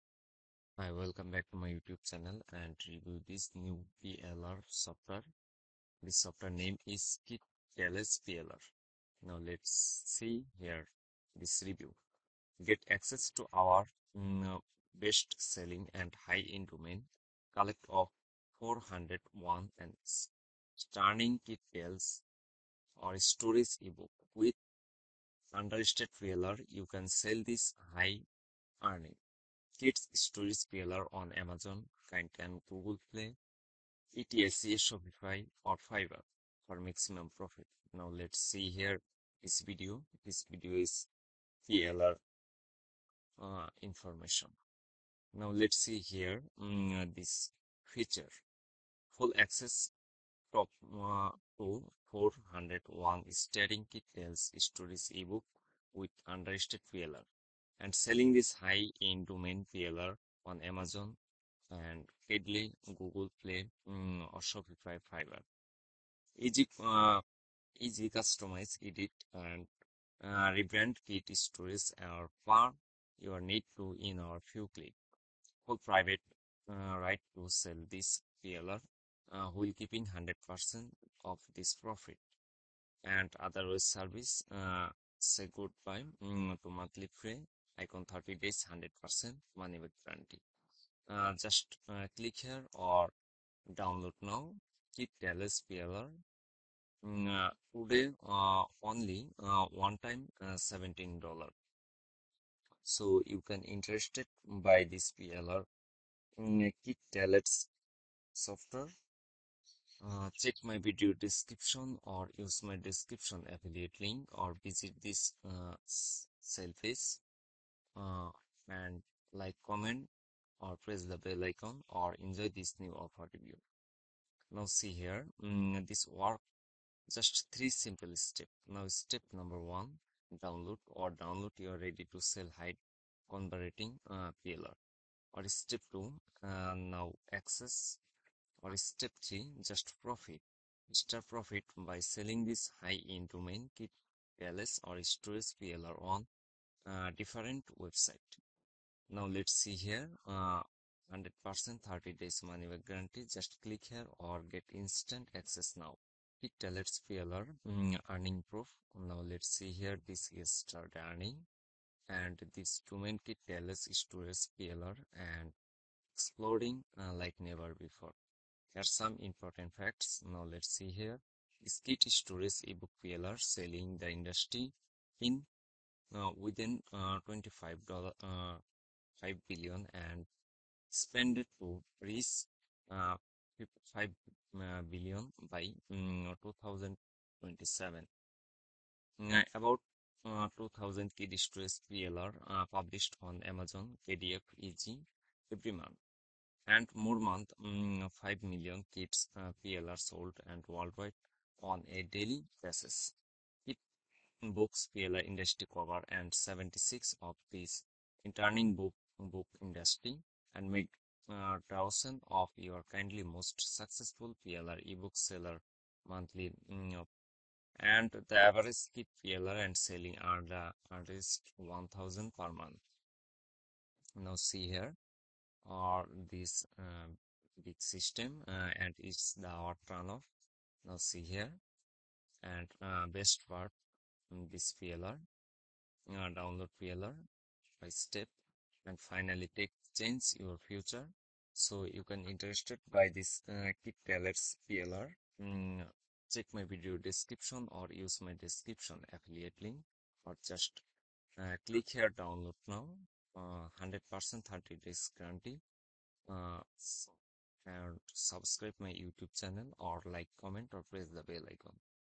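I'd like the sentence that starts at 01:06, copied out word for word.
Easy, uh, easy customize, edit, and uh, rebrand kit stories or far your need to in our few click.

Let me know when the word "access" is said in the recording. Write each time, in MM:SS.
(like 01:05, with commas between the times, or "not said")
00:12, 00:49, 02:17, 02:35.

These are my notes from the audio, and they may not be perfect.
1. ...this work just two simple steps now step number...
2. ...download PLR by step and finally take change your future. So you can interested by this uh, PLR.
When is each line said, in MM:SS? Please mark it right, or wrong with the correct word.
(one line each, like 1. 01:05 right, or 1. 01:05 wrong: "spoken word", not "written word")
1. 02:05 wrong: "three", not "two"
2. 03:56 right.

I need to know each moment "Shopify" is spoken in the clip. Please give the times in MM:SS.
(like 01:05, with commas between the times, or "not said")
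00:34, 01:04.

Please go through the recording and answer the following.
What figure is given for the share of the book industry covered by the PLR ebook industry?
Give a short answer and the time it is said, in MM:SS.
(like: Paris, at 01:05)
76, at 03:26.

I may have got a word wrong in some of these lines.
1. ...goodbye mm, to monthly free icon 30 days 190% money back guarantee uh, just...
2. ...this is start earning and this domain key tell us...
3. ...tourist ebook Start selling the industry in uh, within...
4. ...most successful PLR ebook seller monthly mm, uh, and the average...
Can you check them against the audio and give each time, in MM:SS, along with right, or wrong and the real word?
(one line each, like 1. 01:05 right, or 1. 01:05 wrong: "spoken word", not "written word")
1. 01:25 wrong: "100", not "190"
2. 02:40 right
3. 02:52 wrong: "PLR", not "Start"
4. 03:33 right.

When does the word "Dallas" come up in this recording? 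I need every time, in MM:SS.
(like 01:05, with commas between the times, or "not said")
01:35, 01:47.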